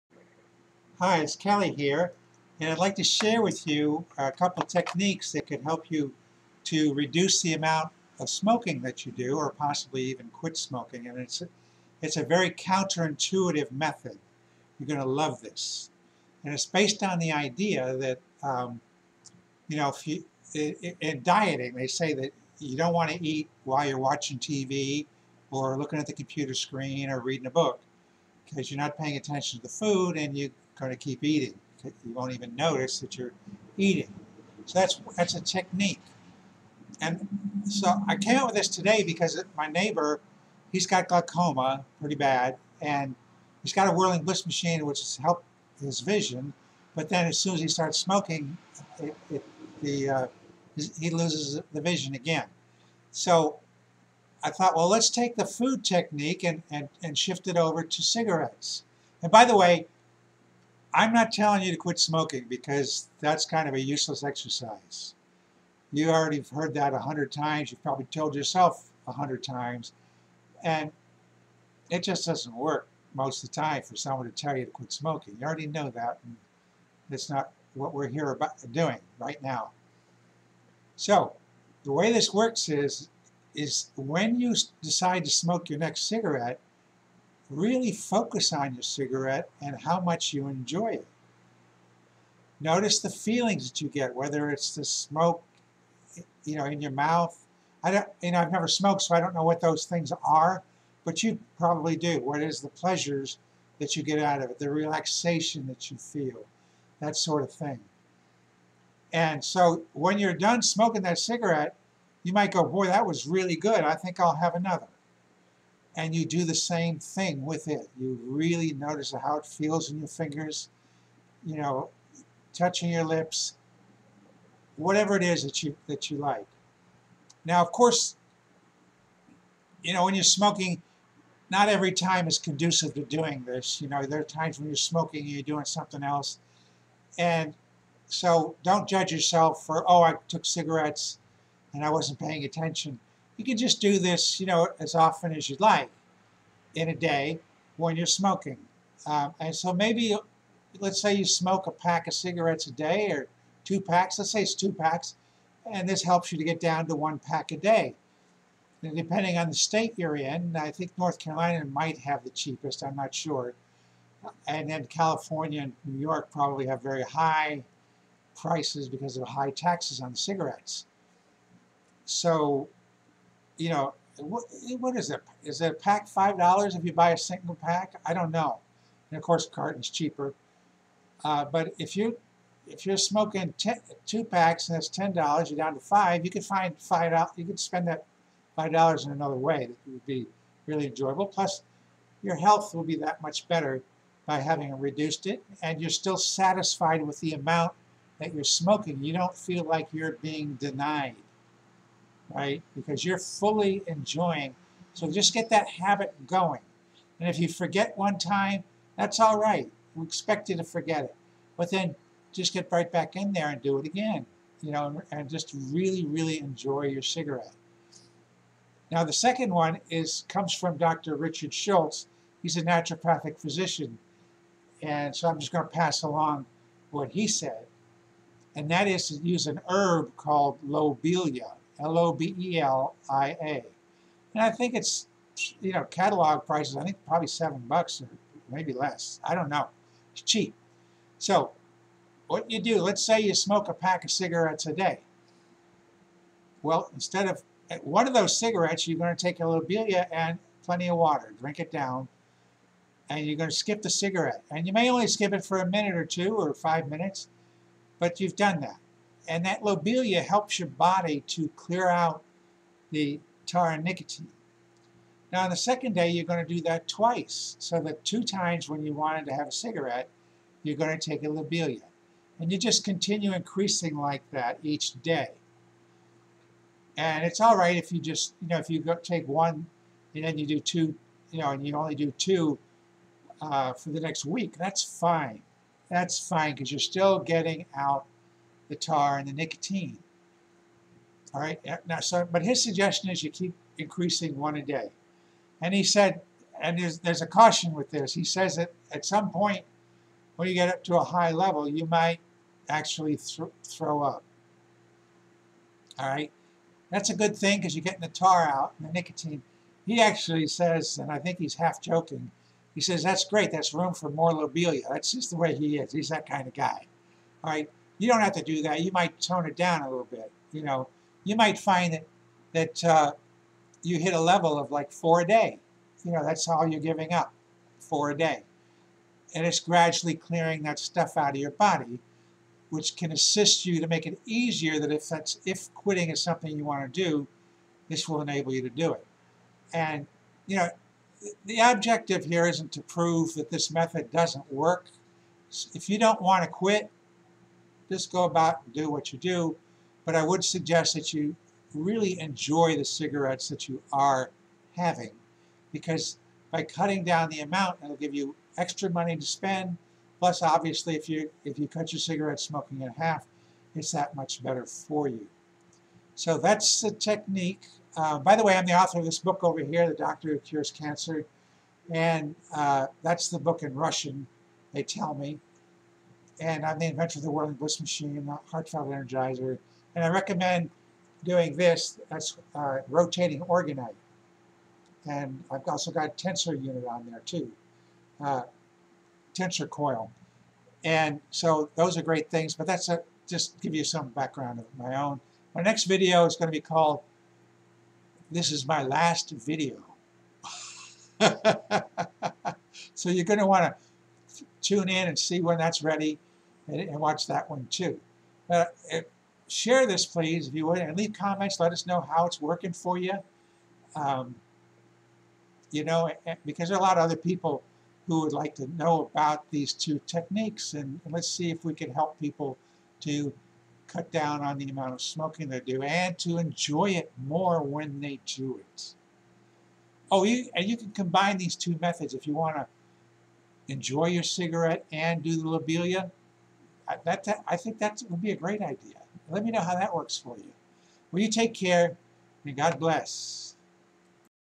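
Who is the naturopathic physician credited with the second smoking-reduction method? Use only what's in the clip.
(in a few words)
Dr. Richard Schulze.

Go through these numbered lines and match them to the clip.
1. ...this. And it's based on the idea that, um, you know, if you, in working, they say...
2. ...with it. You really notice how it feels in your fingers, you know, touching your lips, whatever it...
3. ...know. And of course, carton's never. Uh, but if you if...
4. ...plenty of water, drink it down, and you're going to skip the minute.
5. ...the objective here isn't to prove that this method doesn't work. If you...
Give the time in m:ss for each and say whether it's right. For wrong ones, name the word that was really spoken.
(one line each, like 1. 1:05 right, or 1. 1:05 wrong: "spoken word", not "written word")
1. 0:15 wrong: "dieting", not "working"
2. 1:57 right
3. 2:58 wrong: "cheaper", not "never"
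4. 4:10 wrong: "cigarette", not "minute"
5. 5:41 right.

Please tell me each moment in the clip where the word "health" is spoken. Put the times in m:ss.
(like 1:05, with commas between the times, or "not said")
3:12.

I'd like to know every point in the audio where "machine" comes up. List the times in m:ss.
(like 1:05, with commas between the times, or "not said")
0:44, 6:17.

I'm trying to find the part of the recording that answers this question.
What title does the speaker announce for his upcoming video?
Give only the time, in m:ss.
6:38.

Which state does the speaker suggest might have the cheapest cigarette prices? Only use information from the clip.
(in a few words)
North Carolina.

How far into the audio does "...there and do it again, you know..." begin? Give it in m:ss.
3:33.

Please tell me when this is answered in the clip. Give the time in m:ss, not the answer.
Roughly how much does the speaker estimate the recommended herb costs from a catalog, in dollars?
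3:57.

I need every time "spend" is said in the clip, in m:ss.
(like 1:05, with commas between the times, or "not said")
3:07, 5:59.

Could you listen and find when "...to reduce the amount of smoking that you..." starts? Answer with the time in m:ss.
0:06.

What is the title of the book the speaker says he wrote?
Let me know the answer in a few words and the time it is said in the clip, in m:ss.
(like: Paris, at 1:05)
The Doctor Who Cures Cancer, at 6:09.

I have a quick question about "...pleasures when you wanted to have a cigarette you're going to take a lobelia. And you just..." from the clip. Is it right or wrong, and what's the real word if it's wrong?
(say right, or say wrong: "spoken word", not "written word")
wrong: "times", not "pleasures".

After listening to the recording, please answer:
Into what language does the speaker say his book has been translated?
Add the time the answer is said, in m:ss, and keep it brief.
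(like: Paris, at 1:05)
Russian, at 6:13.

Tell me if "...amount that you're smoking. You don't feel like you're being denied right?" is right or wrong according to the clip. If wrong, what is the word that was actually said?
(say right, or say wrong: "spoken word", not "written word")
right.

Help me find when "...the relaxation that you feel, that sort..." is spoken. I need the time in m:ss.
1:44.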